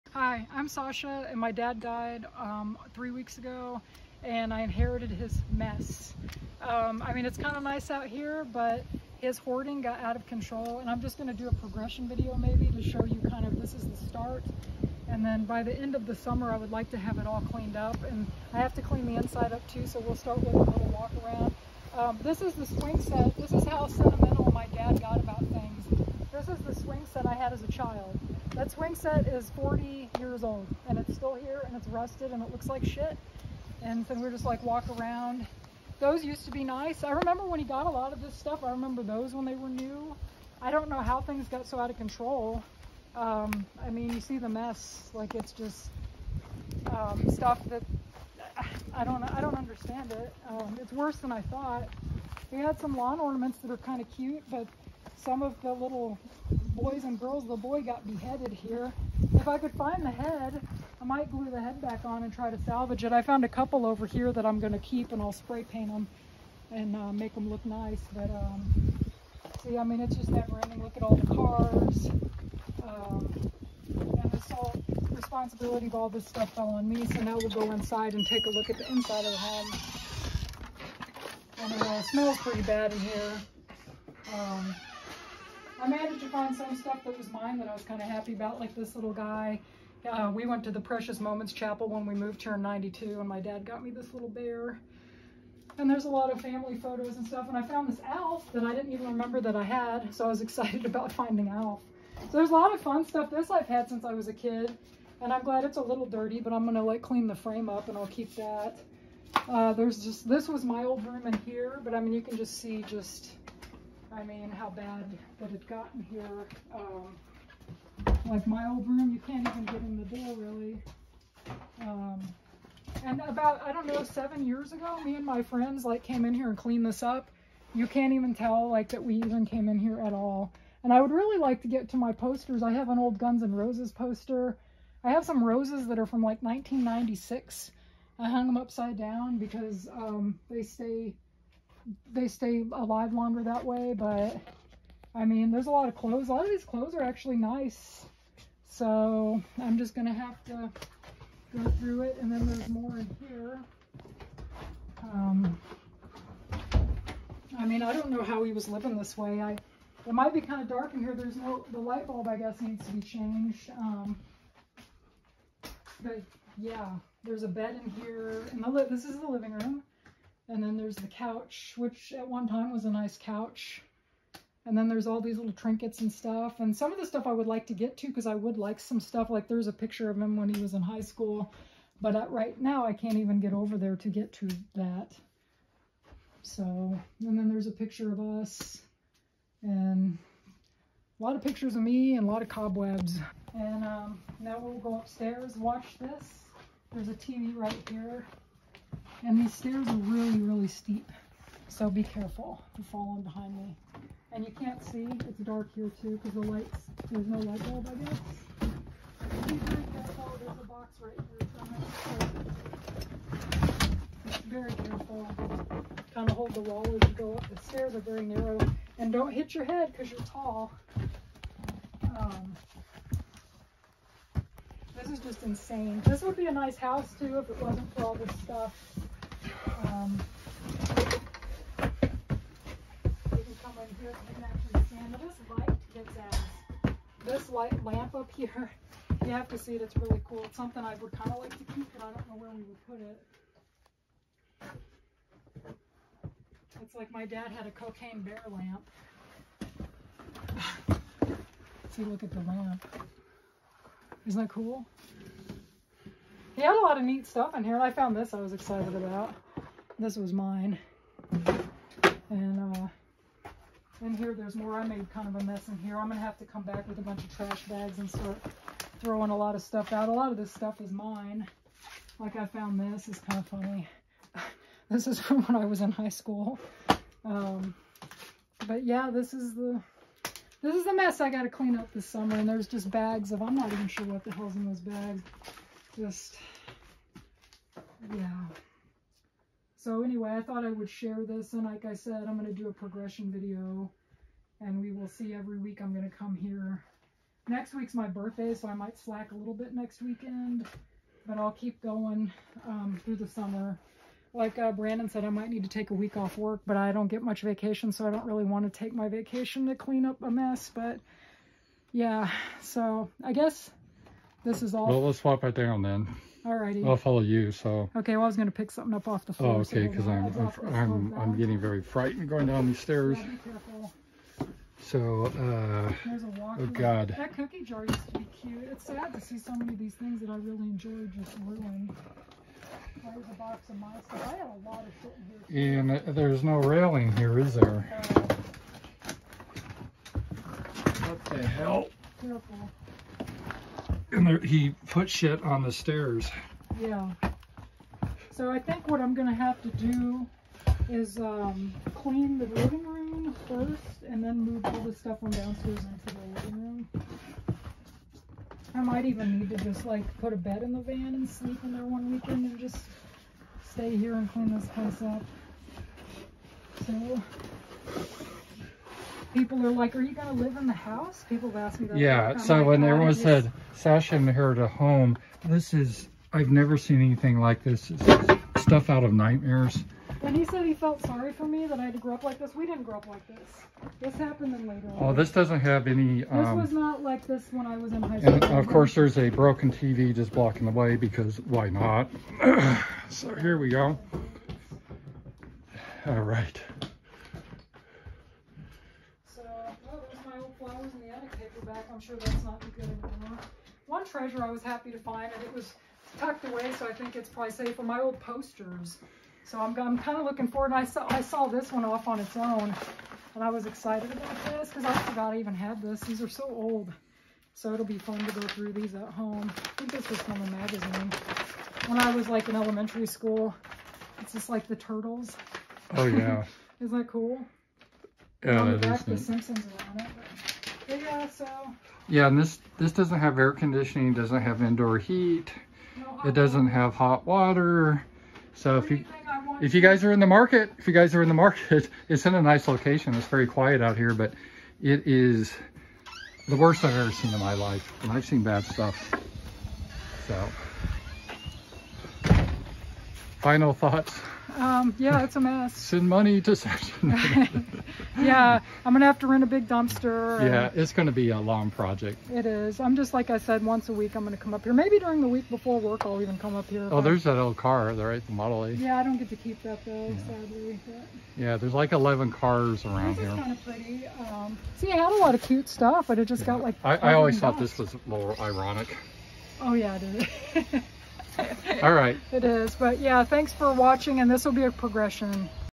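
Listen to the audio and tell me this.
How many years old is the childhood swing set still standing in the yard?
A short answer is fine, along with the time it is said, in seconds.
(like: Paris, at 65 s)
40, at 29 s.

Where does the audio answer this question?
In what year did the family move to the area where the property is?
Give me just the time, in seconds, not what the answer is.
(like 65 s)
92 s.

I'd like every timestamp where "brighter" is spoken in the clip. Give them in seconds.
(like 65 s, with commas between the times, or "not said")
not said.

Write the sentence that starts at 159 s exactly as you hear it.
I It might be kind of dark in here.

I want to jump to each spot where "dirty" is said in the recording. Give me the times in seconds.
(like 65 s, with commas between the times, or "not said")
106 s.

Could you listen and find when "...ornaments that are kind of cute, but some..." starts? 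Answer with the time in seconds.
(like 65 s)
53 s.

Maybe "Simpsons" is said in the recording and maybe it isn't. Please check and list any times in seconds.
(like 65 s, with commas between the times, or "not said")
429 s.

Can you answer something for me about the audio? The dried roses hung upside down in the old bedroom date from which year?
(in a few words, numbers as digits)
1996.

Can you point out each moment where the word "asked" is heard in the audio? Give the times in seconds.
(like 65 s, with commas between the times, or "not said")
371 s.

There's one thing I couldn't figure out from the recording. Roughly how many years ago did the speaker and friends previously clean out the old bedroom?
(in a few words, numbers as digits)
7.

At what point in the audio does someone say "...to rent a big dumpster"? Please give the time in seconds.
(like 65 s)
459 s.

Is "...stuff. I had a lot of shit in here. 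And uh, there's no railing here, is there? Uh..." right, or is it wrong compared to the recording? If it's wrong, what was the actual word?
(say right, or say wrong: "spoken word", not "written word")
right.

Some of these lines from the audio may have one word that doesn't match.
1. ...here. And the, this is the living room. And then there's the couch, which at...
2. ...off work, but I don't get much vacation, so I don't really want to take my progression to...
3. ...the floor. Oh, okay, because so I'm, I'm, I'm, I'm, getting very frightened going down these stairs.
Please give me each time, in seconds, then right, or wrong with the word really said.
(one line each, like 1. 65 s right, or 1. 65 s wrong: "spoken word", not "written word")
1. 168 s right
2. 306 s wrong: "vacation", not "progression"
3. 319 s right.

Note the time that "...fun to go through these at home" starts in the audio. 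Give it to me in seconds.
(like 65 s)
417 s.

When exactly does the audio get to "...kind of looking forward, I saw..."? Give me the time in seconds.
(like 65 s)
409 s.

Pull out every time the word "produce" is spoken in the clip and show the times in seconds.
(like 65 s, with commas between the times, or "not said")
not said.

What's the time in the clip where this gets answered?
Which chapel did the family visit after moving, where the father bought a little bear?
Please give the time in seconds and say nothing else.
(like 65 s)
90 s.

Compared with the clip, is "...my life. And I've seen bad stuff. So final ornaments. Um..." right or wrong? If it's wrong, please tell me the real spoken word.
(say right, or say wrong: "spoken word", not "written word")
wrong: "thoughts", not "ornaments".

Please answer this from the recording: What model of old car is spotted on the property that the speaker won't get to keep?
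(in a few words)
Model A.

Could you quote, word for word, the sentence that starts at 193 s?
And um, now we'll go upstairs, watch this.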